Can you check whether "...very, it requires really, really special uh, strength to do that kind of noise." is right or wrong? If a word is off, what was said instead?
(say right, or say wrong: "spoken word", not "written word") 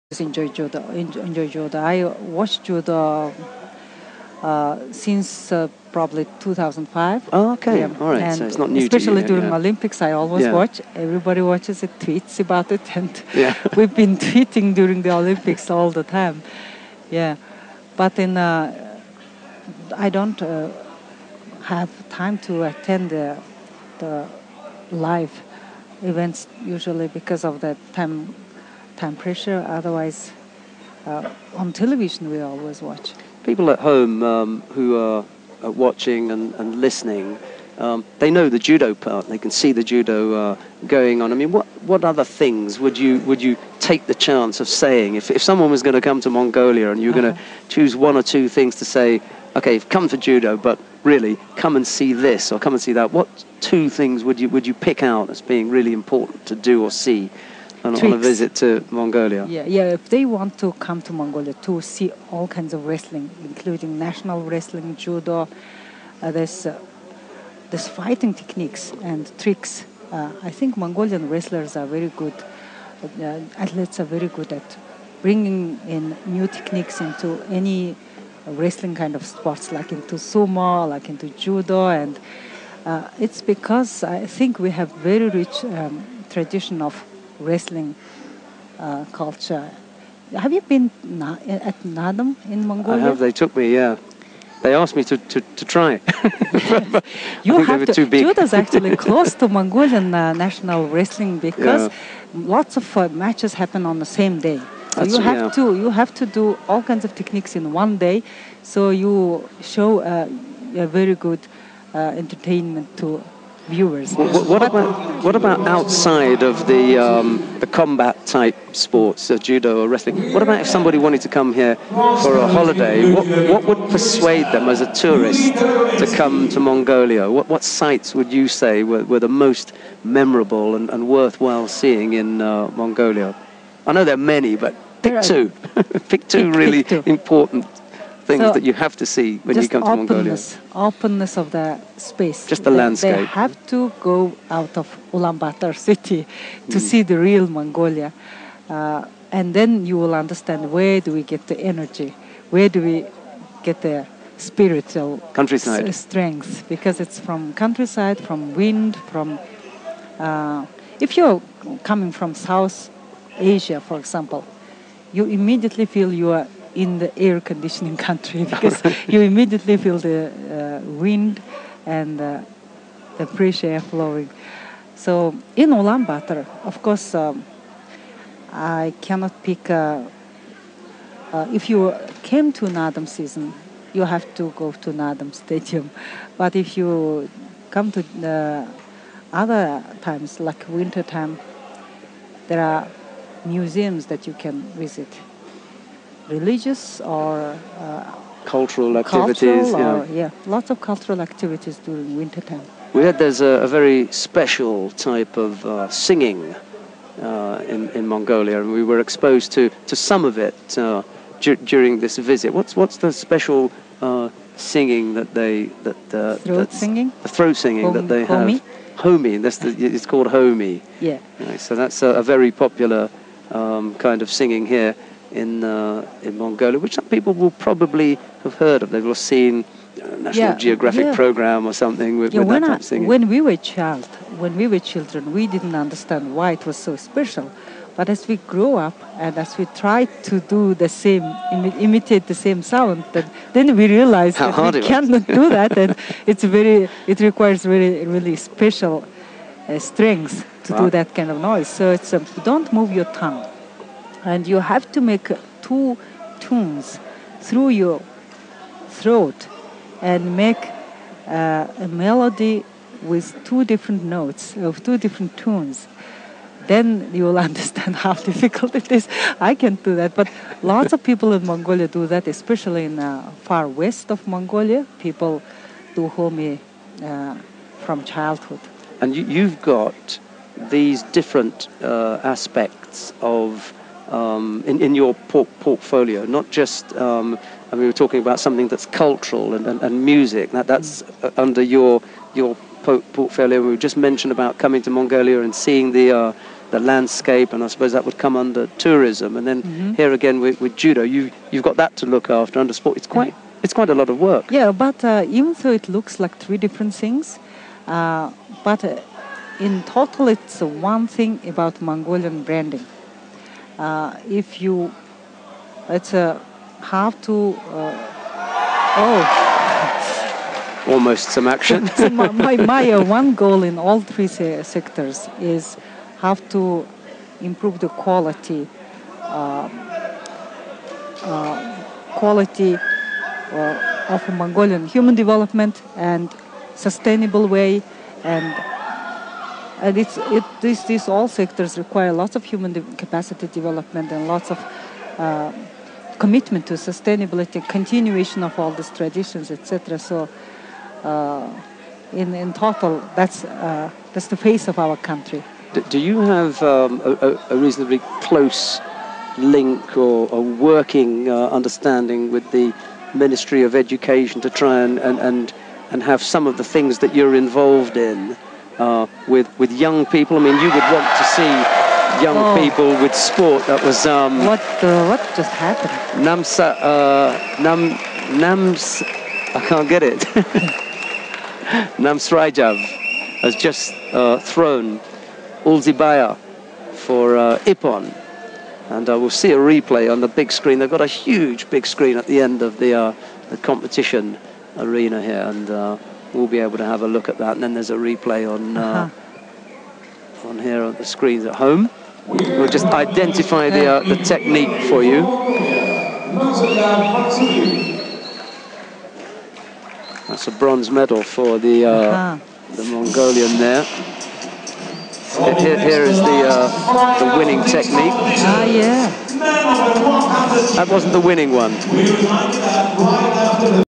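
right.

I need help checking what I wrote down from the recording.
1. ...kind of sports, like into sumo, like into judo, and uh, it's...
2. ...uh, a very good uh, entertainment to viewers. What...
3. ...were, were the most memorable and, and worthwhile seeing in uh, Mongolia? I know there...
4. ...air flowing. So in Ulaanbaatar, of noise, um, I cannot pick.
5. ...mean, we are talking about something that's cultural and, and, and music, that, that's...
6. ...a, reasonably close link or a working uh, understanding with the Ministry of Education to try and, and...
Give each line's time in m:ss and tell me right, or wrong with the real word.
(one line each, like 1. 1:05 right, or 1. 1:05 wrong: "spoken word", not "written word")
1. 1:18 right
2. 1:50 right
3. 2:08 right
4. 2:53 wrong: "course", not "noise"
5. 4:47 right
6. 5:57 right.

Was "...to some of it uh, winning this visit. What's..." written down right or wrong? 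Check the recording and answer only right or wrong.
wrong.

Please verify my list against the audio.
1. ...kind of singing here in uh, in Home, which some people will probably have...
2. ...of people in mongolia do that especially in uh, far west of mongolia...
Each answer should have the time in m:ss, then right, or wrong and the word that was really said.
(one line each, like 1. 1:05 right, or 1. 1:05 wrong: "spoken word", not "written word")
1. 3:43 wrong: "Mongolia", not "Home"
2. 4:30 right.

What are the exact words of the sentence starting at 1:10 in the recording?
Uh, I think Mongolian wrestlers are very good.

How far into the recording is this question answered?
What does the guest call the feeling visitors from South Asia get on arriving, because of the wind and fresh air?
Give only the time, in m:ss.
2:47.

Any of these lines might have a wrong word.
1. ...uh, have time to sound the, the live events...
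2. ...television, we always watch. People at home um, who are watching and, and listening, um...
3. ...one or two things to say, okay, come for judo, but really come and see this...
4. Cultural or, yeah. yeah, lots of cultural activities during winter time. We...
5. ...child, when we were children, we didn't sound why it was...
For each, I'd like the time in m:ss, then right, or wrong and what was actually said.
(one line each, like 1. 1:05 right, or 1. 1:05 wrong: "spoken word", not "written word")
1. 0:20 wrong: "attend", not "sound"
2. 0:31 right
3. 0:47 right
4. 3:19 right
5. 3:53 wrong: "understand", not "sound".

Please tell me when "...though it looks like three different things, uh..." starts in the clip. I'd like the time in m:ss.
5:05.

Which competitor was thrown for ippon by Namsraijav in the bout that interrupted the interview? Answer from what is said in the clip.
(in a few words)
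UlziiBayar.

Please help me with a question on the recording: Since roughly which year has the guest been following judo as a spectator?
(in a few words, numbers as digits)
2005.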